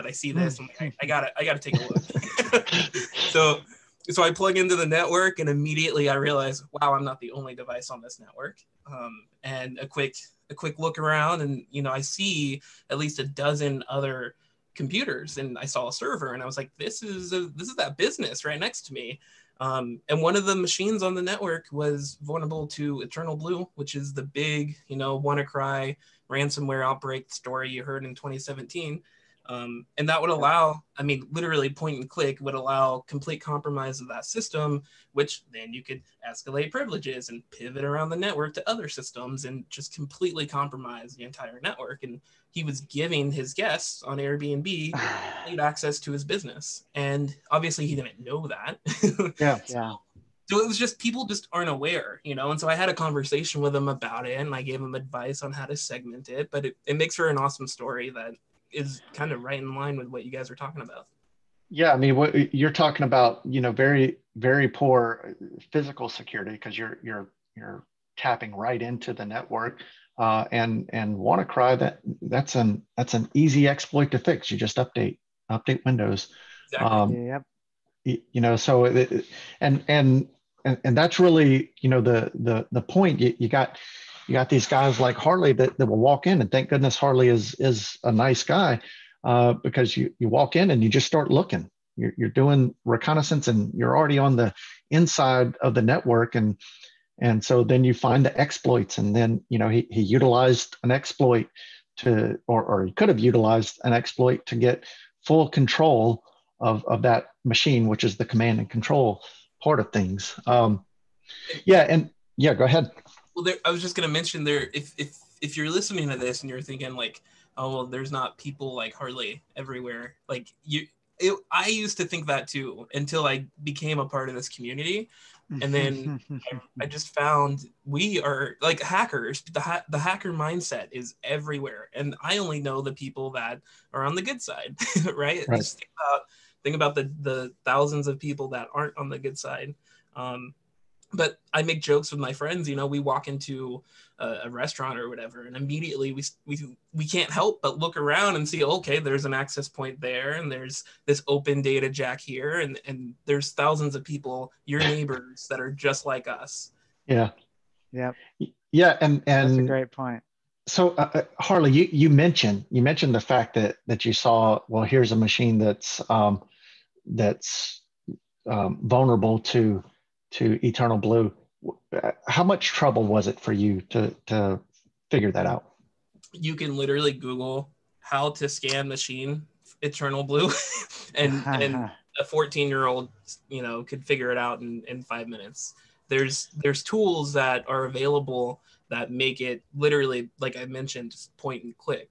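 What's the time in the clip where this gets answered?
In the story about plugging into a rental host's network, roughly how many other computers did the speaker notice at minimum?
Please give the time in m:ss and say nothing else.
0:13.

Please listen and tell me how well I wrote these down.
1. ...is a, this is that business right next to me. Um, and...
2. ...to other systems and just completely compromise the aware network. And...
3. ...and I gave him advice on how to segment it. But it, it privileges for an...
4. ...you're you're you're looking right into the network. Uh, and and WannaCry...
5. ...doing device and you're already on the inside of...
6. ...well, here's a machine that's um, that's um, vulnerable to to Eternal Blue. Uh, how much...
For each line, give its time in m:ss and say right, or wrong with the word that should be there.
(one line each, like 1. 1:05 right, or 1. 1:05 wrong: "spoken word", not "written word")
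1. 0:17 right
2. 0:38 wrong: "entire", not "aware"
3. 0:54 wrong: "makes", not "privileges"
4. 1:06 wrong: "tapping", not "looking"
5. 1:32 wrong: "reconnaissance", not "device"
6. 2:44 right.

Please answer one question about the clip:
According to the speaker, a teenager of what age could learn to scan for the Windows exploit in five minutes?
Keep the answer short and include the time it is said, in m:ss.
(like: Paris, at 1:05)
14, at 3:02.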